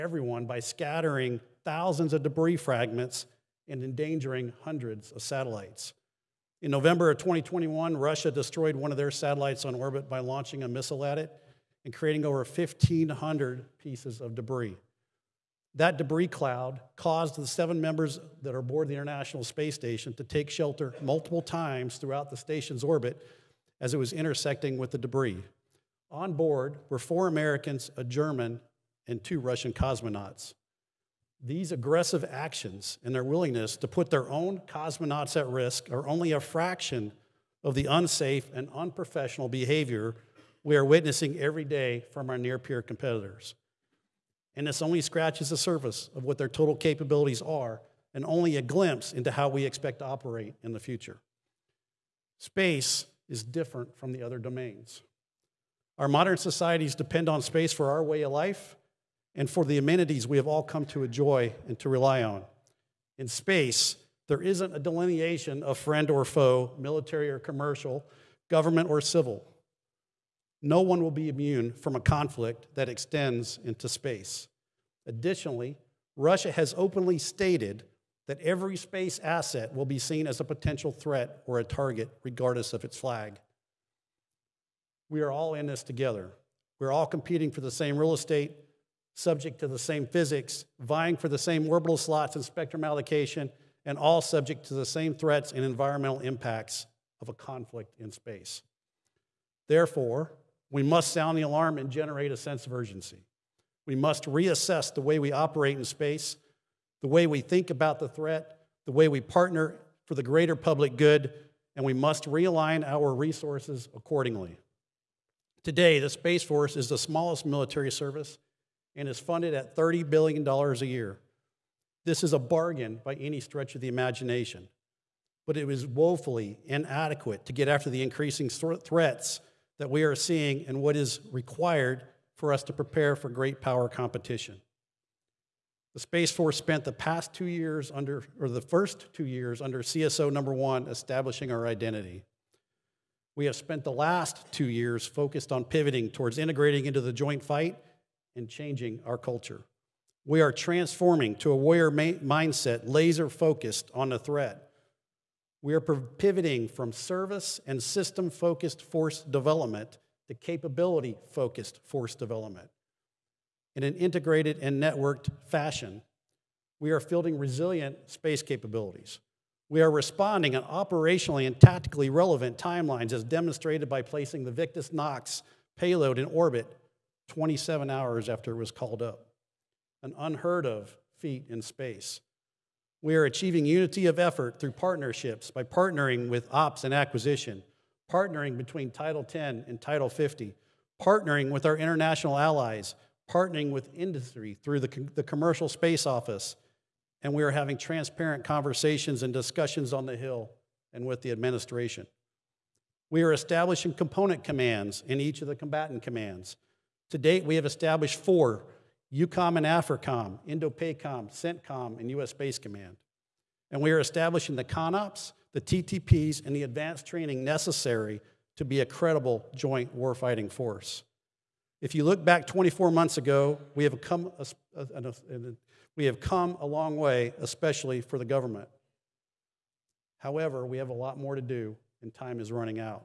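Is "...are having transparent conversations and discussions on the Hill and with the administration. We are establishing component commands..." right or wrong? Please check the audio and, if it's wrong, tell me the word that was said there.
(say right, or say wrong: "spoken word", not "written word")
right.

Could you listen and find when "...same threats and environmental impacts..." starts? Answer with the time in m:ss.
1:34.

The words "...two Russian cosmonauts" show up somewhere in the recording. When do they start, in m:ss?
0:29.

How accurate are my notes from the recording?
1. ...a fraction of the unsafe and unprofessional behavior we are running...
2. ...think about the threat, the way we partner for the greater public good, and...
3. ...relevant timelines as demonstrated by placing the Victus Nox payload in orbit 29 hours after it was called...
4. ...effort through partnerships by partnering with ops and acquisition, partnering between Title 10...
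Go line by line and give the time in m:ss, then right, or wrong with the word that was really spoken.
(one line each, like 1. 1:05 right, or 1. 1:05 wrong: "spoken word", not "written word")
1. 0:36 wrong: "witnessing", not "running"
2. 1:47 right
3. 2:52 wrong: "27", not "29"
4. 3:04 right.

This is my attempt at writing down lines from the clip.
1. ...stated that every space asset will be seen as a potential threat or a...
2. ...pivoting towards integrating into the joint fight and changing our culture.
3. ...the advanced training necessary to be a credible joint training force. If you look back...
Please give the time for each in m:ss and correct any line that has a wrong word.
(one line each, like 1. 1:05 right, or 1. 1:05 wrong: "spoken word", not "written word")
1. 1:17 right
2. 2:25 right
3. 3:36 wrong: "warfighting", not "training".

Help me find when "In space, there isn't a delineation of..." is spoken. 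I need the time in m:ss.
1:03.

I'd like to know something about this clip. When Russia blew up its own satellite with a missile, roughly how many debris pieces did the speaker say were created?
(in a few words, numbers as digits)
Over 1,500.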